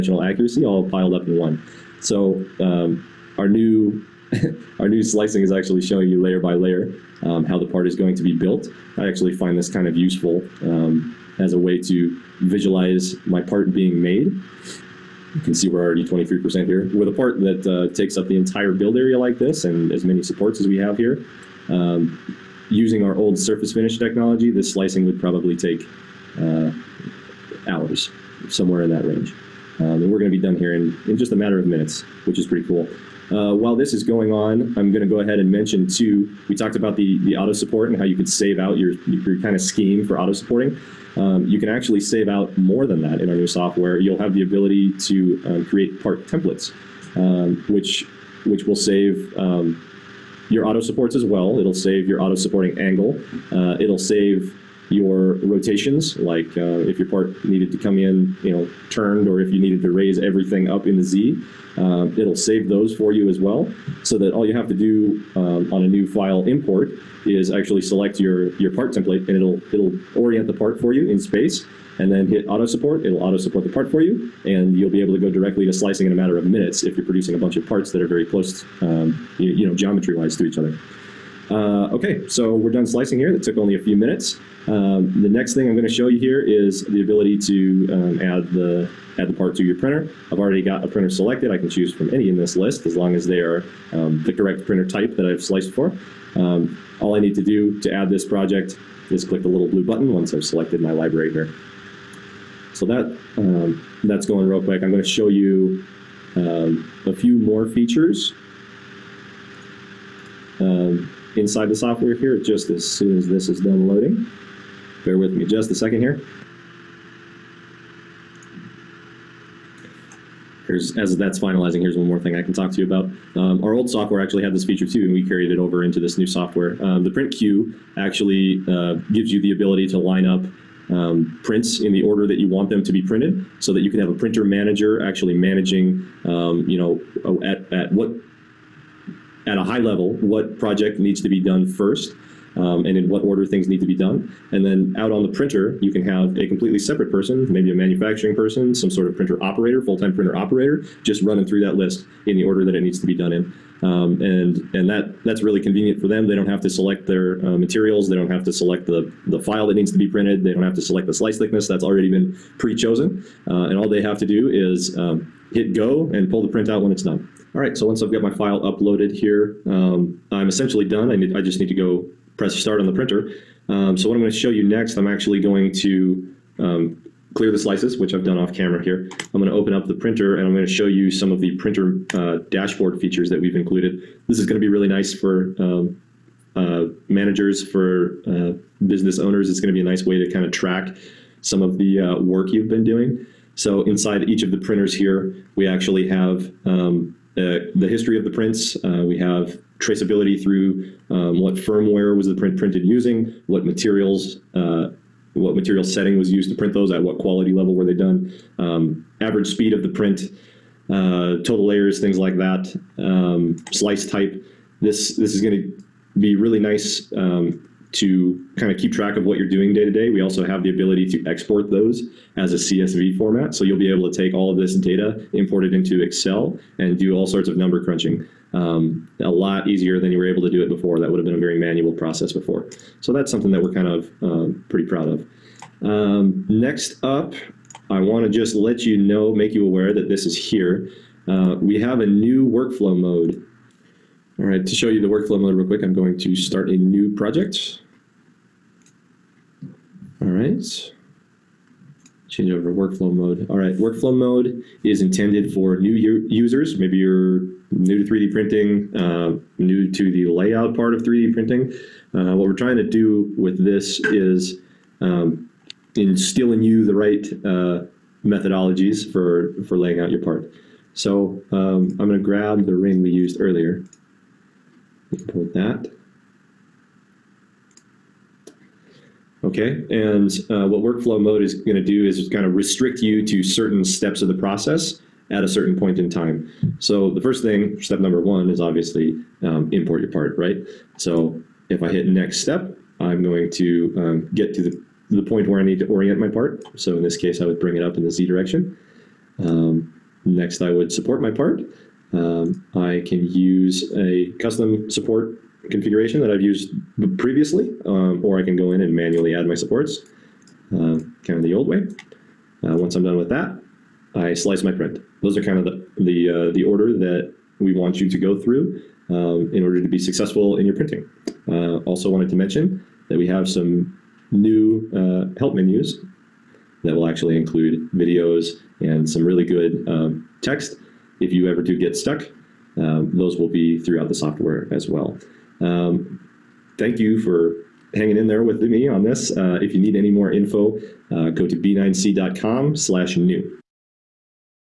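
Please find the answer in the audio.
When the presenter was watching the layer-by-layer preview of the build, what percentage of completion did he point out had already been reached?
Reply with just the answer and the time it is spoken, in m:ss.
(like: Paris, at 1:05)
23%, at 0:16.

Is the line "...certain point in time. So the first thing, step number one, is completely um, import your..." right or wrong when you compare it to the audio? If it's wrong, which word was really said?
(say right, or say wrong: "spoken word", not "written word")
wrong: "obviously", not "completely".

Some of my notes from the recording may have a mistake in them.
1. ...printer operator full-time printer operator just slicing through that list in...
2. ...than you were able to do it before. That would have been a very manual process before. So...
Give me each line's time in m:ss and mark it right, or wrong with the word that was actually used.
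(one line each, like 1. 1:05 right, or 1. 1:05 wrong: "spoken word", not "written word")
1. 2:29 wrong: "running", not "slicing"
2. 3:49 right.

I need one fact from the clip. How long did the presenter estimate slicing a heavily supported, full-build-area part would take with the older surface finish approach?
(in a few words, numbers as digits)
hours.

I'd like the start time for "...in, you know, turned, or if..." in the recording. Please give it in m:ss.
0:57.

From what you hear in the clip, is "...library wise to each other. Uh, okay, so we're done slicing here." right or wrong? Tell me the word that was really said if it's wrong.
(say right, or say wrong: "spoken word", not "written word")
wrong: "geometry", not "library".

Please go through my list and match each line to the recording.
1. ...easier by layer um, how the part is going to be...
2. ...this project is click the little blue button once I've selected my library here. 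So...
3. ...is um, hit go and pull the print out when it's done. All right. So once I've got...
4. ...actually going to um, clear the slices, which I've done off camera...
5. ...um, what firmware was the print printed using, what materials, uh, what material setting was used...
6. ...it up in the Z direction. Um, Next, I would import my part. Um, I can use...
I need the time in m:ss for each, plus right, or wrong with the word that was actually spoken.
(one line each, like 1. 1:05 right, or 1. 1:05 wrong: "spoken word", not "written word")
1. 0:06 wrong: "layer", not "easier"
2. 1:38 right
3. 2:44 right
4. 2:55 right
5. 3:21 right
6. 4:57 wrong: "support", not "import".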